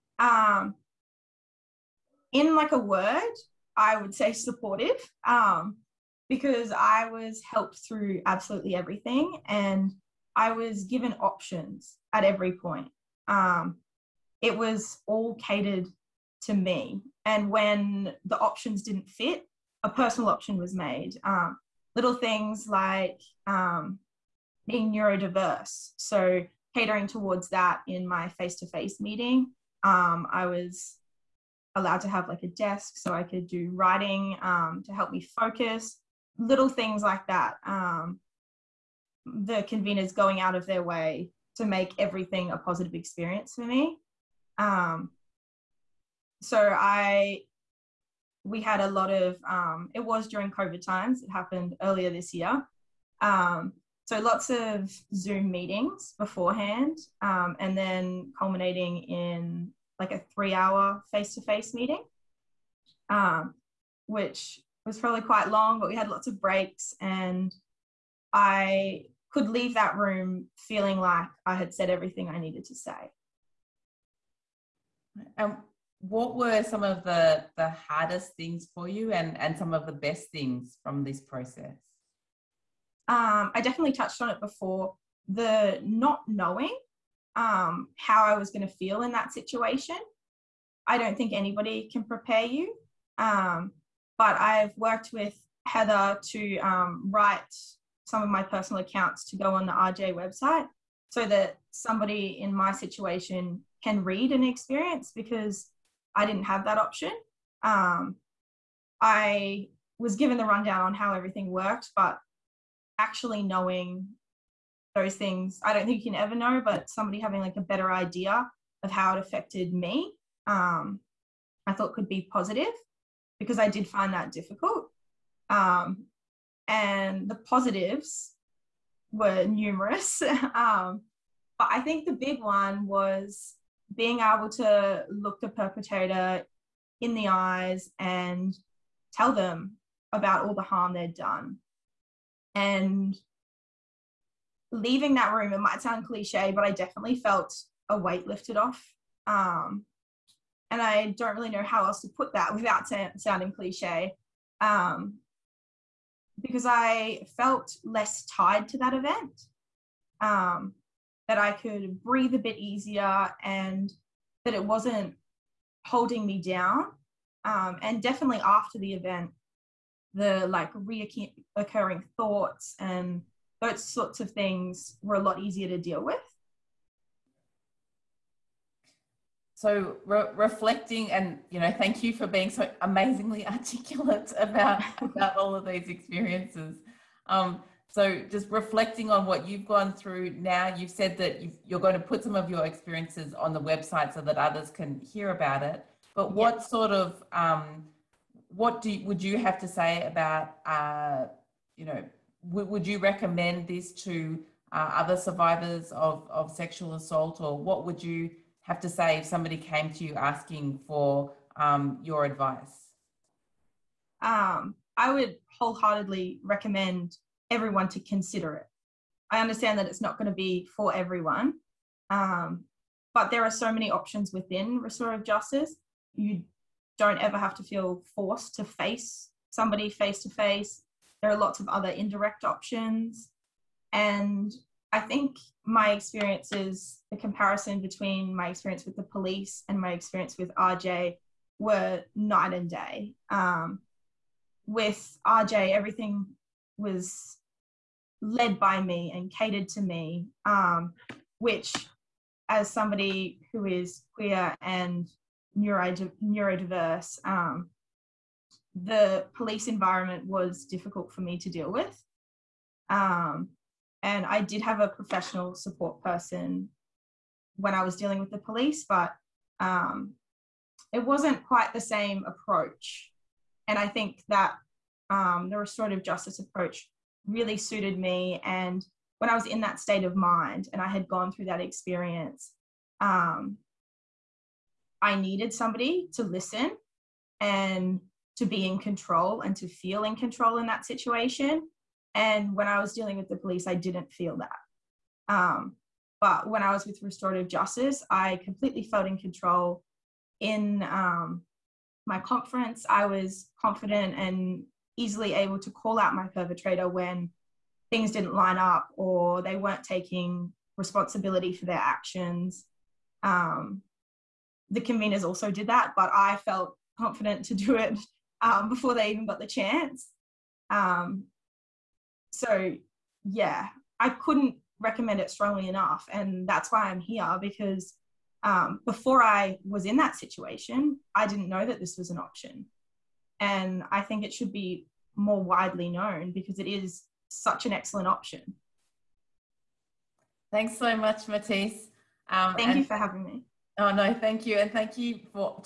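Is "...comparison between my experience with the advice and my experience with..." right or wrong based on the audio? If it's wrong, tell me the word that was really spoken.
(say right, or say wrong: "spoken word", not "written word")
wrong: "police", not "advice".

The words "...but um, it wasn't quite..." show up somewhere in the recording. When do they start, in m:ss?
4:28.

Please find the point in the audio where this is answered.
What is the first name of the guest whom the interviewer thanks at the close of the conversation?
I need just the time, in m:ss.
5:41.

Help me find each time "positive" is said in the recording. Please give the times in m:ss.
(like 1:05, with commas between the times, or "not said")
0:42, 2:02, 2:07.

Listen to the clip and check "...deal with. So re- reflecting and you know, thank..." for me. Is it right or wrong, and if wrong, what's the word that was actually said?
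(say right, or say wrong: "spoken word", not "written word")
right.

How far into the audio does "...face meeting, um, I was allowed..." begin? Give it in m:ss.
0:28.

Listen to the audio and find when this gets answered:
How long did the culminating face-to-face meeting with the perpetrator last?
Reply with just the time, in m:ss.
1:00.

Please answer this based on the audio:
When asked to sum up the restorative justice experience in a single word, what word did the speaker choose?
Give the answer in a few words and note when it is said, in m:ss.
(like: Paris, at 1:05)
Supportive, at 0:04.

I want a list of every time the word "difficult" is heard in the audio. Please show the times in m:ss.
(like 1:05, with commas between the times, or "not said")
2:04, 4:20.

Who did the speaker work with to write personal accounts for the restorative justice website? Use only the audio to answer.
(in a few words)
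Heather.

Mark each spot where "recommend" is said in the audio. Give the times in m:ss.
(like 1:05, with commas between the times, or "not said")
3:22, 3:36, 5:24.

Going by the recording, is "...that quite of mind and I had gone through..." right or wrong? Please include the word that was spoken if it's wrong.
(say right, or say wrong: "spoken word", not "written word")
wrong: "state", not "quite".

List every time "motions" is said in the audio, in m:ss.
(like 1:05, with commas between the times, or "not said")
not said.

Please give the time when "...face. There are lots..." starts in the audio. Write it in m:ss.
3:50.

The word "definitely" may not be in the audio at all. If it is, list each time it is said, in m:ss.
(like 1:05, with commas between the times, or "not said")
1:23, 2:26, 2:48.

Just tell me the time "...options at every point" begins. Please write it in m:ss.
0:11.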